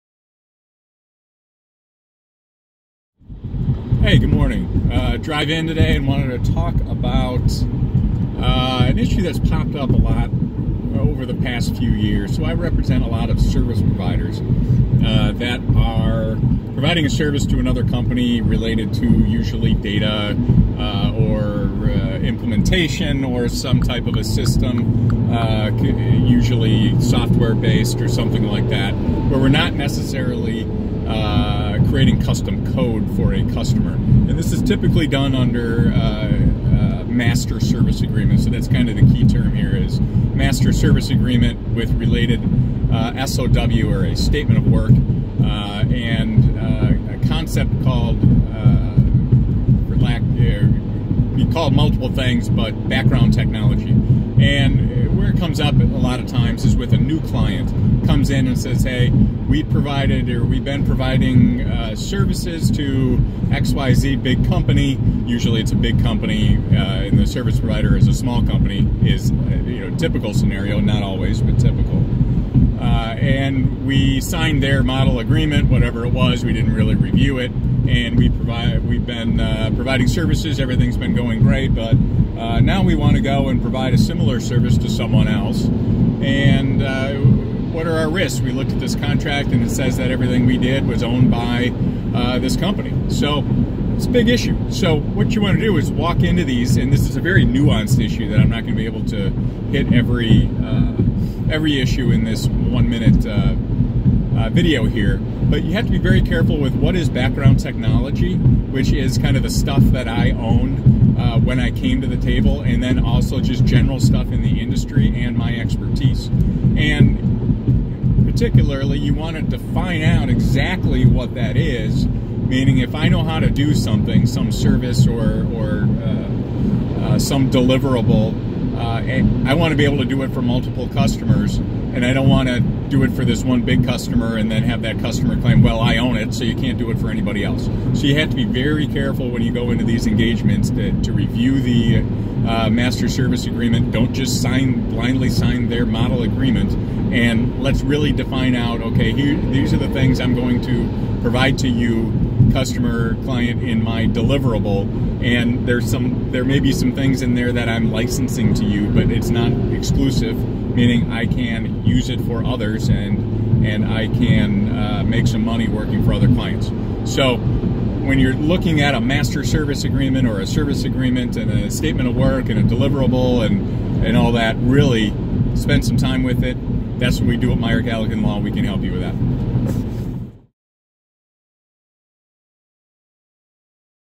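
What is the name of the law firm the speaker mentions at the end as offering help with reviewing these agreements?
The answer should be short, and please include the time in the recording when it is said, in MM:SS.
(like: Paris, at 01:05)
Meyer Galligan Law, at 02:57.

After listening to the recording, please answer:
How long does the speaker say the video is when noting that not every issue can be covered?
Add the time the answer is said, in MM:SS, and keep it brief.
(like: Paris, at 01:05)
one minute, at 01:42.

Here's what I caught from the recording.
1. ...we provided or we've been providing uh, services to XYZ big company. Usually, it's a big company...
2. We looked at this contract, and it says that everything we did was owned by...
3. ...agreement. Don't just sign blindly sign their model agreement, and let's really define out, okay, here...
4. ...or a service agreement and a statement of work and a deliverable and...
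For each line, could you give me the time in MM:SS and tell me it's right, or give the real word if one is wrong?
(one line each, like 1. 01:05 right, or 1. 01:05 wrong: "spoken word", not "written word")
1. 00:59 right
2. 01:28 right
3. 02:23 right
4. 02:50 right.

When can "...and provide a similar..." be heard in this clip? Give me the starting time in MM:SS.
01:23.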